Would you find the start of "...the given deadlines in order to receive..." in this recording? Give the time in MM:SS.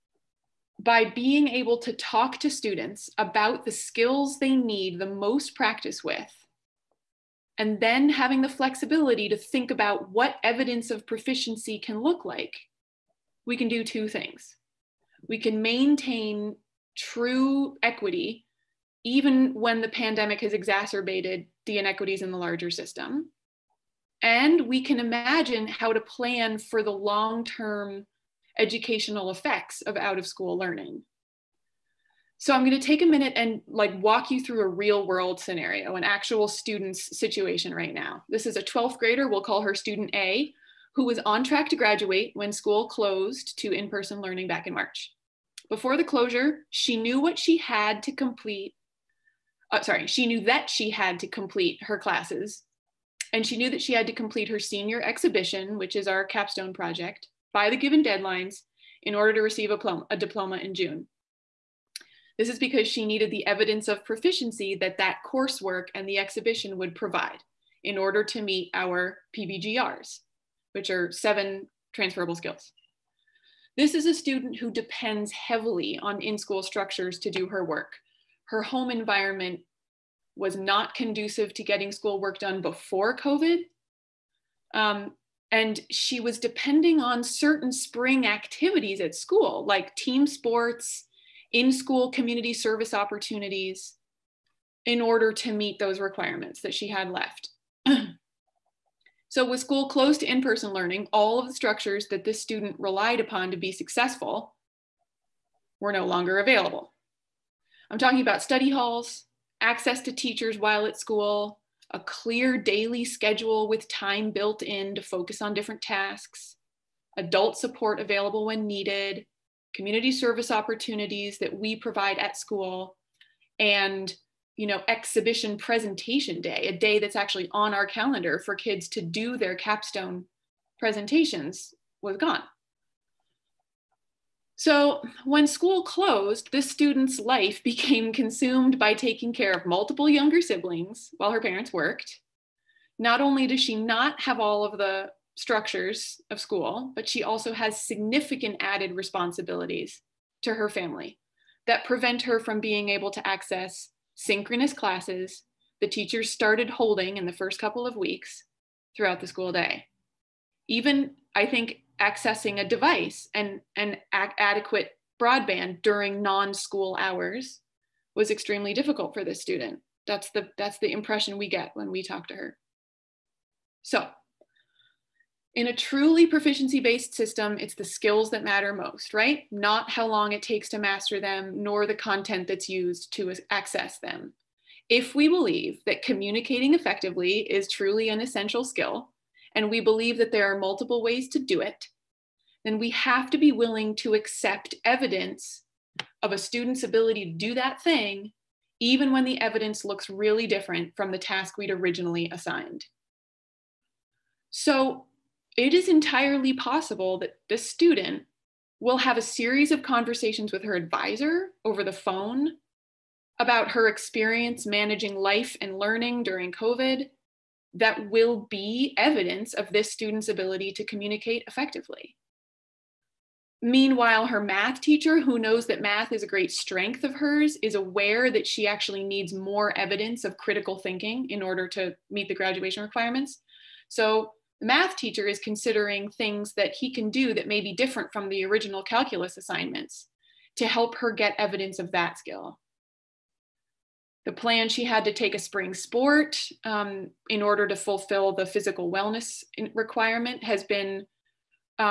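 00:57.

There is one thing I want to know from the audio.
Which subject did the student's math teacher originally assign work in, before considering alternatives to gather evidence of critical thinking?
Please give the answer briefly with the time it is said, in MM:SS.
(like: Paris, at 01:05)
calculus, at 03:58.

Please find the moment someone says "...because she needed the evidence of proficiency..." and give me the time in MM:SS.
01:02.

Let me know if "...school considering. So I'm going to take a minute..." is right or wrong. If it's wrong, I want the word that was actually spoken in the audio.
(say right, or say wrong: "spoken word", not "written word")
wrong: "learning", not "considering".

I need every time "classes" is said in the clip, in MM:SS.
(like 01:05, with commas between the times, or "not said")
00:51, 02:34.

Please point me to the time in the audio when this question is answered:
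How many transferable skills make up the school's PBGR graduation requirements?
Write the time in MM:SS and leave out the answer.
01:11.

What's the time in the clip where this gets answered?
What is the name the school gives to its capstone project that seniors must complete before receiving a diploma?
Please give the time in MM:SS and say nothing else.
00:54.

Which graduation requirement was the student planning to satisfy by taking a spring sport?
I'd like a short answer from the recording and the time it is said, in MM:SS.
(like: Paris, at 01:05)
physical wellness, at 04:08.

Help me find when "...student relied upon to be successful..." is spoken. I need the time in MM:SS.
01:42.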